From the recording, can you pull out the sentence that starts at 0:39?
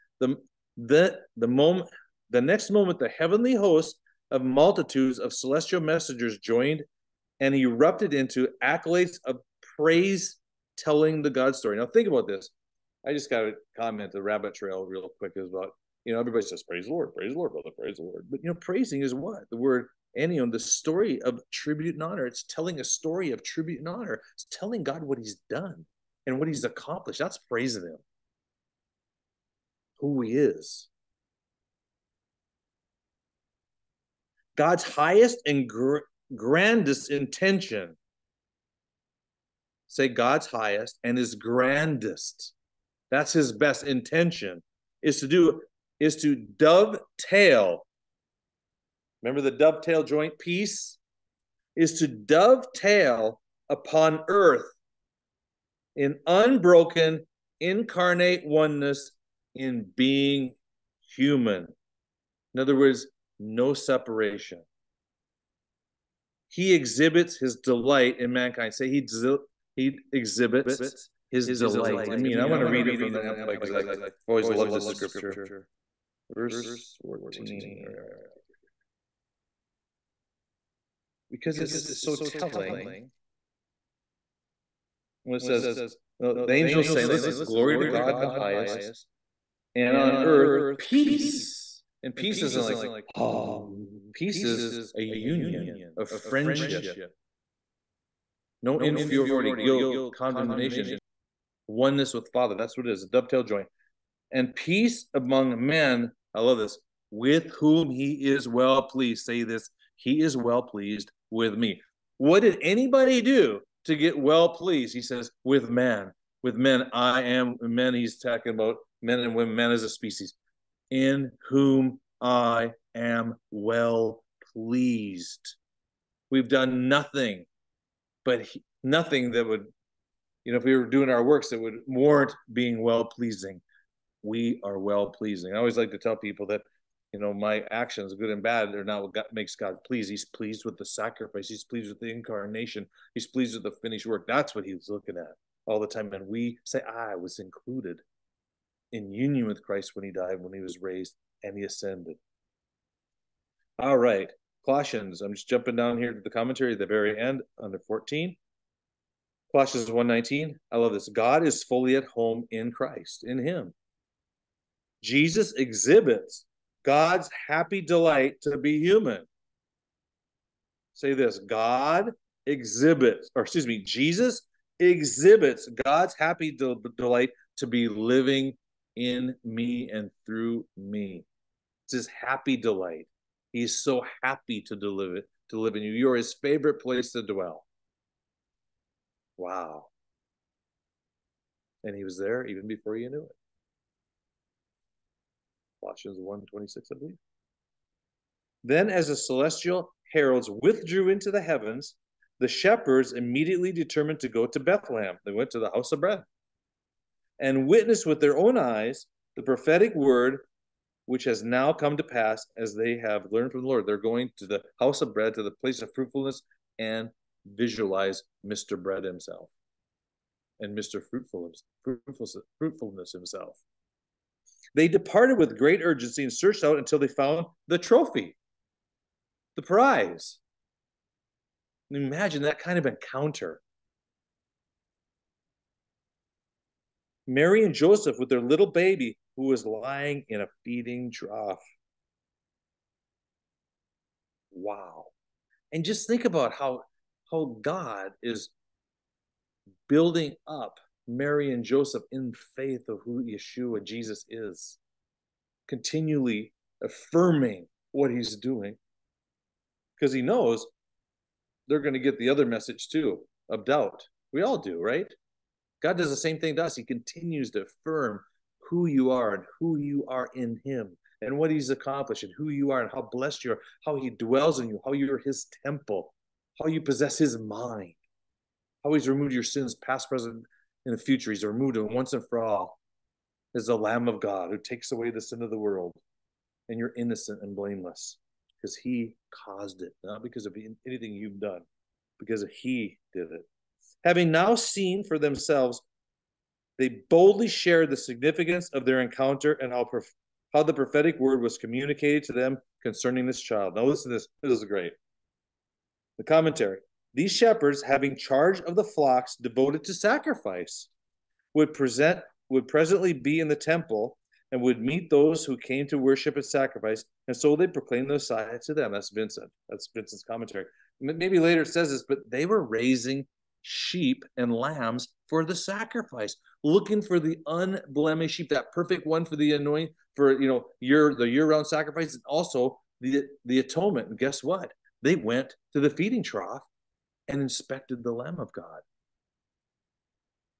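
Say God's highest and his grandest that's his best intention is to do is to dovetail.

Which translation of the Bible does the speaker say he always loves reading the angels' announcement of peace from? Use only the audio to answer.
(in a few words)
Amplified.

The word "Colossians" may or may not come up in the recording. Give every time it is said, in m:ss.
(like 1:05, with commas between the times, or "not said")
2:34, 2:39, 3:15.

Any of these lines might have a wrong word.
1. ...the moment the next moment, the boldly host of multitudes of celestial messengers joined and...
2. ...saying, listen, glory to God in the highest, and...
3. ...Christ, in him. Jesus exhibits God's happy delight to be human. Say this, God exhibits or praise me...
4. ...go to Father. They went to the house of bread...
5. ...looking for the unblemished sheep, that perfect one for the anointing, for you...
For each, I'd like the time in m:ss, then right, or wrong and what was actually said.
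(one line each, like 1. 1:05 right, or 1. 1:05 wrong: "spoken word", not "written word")
1. 0:01 wrong: "heavenly", not "boldly"
2. 1:26 right
3. 2:42 wrong: "excuse", not "praise"
4. 3:24 wrong: "Bethlehem", not "Father"
5. 5:26 right.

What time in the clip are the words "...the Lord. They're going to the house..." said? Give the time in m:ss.
3:33.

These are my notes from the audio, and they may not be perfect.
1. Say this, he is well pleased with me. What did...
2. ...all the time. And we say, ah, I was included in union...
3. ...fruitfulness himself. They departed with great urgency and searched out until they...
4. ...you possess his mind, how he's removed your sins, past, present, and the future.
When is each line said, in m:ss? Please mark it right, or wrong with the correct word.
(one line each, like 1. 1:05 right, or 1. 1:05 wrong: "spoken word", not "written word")
1. 1:49 right
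2. 2:25 right
3. 3:42 right
4. 4:36 right.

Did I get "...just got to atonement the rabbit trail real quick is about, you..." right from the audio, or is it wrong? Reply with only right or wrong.
wrong.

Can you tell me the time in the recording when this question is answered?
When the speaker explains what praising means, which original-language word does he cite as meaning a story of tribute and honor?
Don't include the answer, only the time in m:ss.
0:20.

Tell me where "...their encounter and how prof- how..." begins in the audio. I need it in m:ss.
4:58.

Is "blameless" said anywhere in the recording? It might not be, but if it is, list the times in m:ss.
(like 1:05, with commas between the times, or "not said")
4:47.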